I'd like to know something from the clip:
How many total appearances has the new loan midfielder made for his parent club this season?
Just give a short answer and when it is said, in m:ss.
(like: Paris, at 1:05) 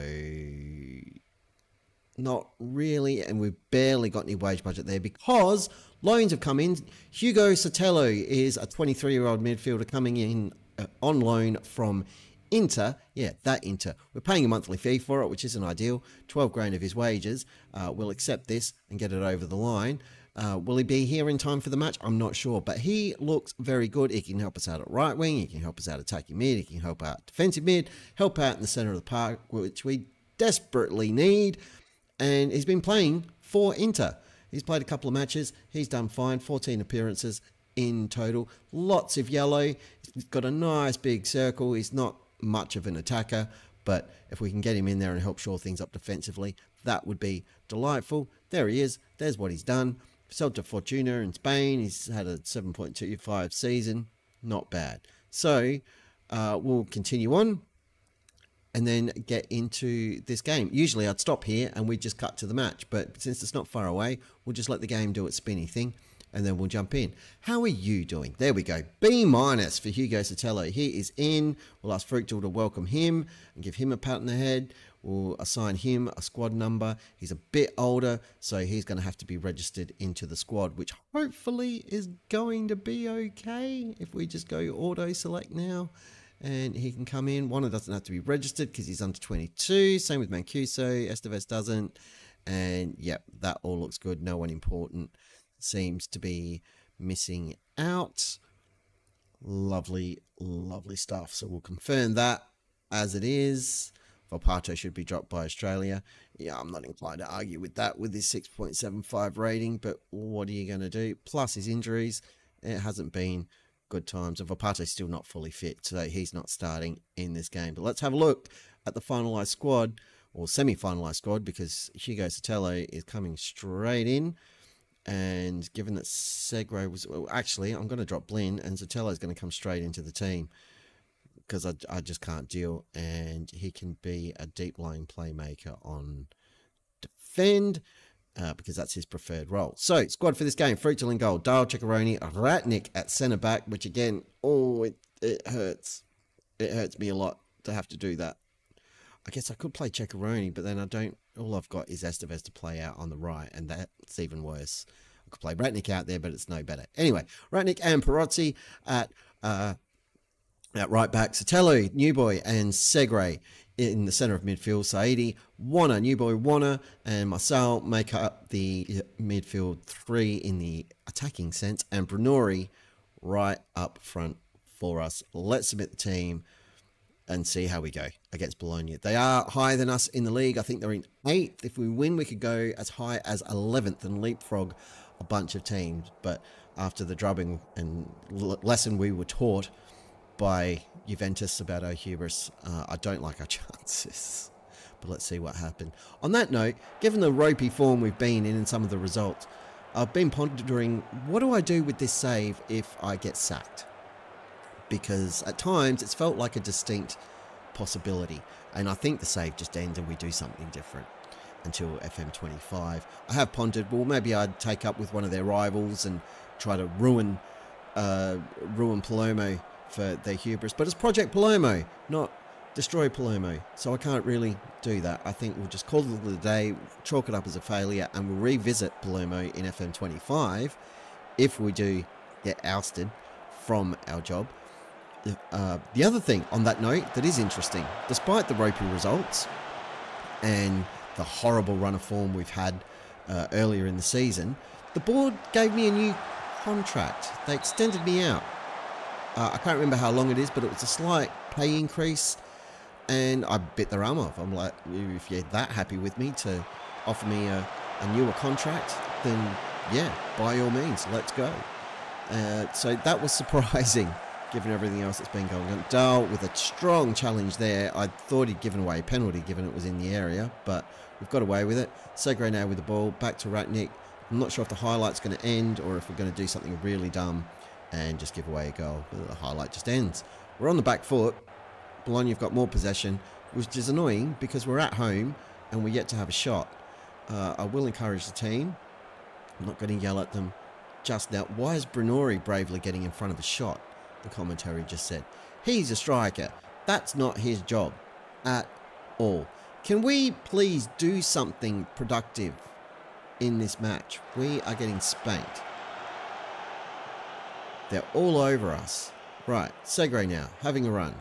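14, at 0:36.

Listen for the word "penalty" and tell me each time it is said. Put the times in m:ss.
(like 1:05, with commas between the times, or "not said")
4:29.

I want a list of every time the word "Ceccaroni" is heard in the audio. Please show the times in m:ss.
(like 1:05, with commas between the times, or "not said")
2:21, 2:29.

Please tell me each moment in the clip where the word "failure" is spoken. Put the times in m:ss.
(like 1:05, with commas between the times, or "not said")
3:47.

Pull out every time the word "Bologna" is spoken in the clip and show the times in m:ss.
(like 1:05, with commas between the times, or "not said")
2:58, 4:42.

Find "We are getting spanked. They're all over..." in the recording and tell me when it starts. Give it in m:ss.
5:04.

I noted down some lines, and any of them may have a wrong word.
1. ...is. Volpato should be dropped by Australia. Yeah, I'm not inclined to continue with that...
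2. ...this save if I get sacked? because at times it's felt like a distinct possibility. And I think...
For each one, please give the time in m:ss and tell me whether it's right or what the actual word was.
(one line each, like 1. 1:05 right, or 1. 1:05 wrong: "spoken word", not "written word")
1. 1:43 wrong: "argue", not "continue"
2. 3:21 right.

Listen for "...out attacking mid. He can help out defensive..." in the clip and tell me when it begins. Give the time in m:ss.
0:25.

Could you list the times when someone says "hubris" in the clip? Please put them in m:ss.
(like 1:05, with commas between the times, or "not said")
3:11, 3:40.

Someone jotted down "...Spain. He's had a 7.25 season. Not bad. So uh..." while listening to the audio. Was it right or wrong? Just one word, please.
right.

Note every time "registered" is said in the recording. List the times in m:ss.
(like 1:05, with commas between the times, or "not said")
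1:19, 1:28.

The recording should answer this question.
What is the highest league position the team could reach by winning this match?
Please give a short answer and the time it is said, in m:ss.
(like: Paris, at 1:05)
11th, at 3:03.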